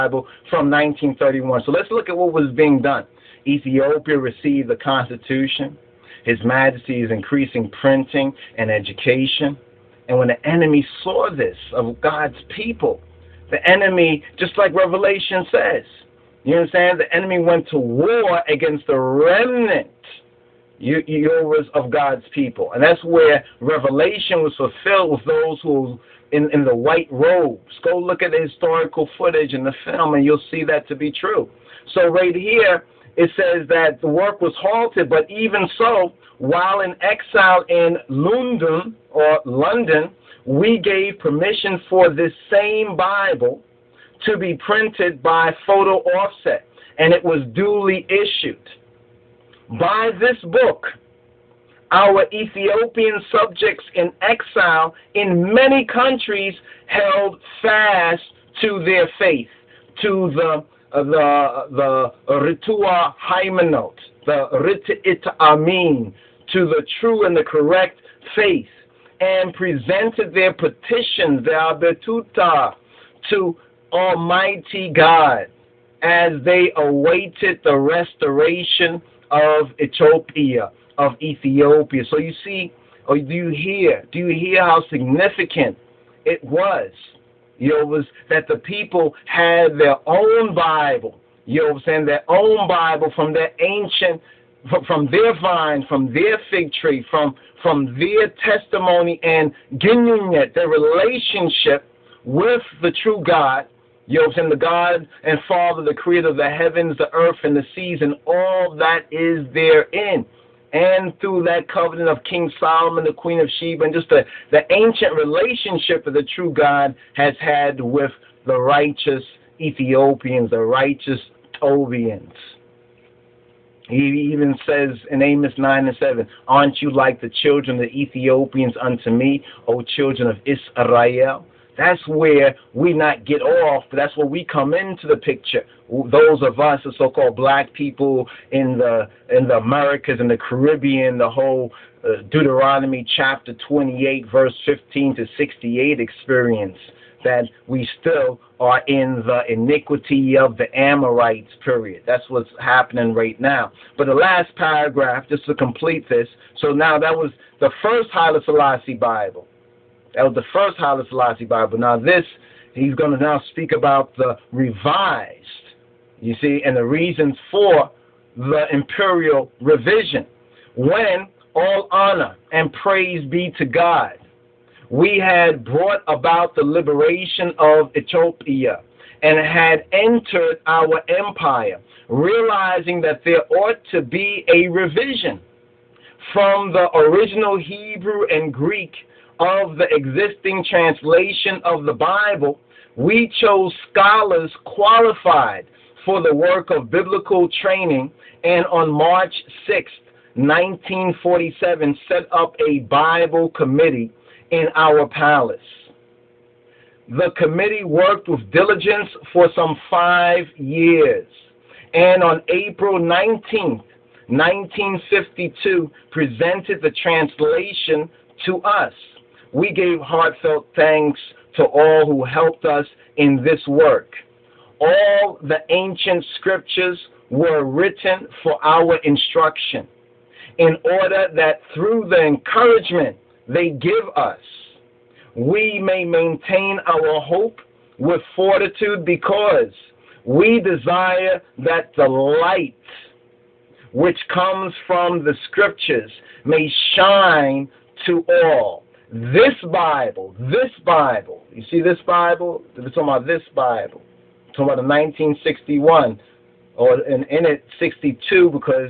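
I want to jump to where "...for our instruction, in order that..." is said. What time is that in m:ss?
3:48.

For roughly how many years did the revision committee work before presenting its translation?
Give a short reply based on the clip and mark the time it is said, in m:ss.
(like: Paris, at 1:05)
5 years, at 3:29.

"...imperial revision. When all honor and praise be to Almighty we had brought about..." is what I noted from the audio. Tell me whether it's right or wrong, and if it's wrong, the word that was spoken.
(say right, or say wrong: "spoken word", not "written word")
wrong: "God", not "Almighty".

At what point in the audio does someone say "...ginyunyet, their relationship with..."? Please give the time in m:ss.
1:39.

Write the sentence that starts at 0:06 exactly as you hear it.
His Majesty is increasing printing and education.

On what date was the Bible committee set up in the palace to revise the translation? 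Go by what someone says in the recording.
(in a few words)
March 6, 1947.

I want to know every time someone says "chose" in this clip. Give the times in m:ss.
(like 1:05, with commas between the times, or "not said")
3:13.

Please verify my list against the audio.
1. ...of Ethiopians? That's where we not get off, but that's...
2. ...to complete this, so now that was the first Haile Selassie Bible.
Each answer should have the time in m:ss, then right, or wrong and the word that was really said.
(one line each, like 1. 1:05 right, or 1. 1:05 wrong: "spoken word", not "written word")
1. 2:10 wrong: "Israel", not "Ethiopians"
2. 2:35 right.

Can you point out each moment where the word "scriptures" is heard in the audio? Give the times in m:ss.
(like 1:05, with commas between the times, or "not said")
3:46, 4:05.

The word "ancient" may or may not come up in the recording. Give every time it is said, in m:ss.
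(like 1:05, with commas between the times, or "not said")
1:33, 1:54, 3:45.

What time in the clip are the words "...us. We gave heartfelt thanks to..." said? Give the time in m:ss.
3:38.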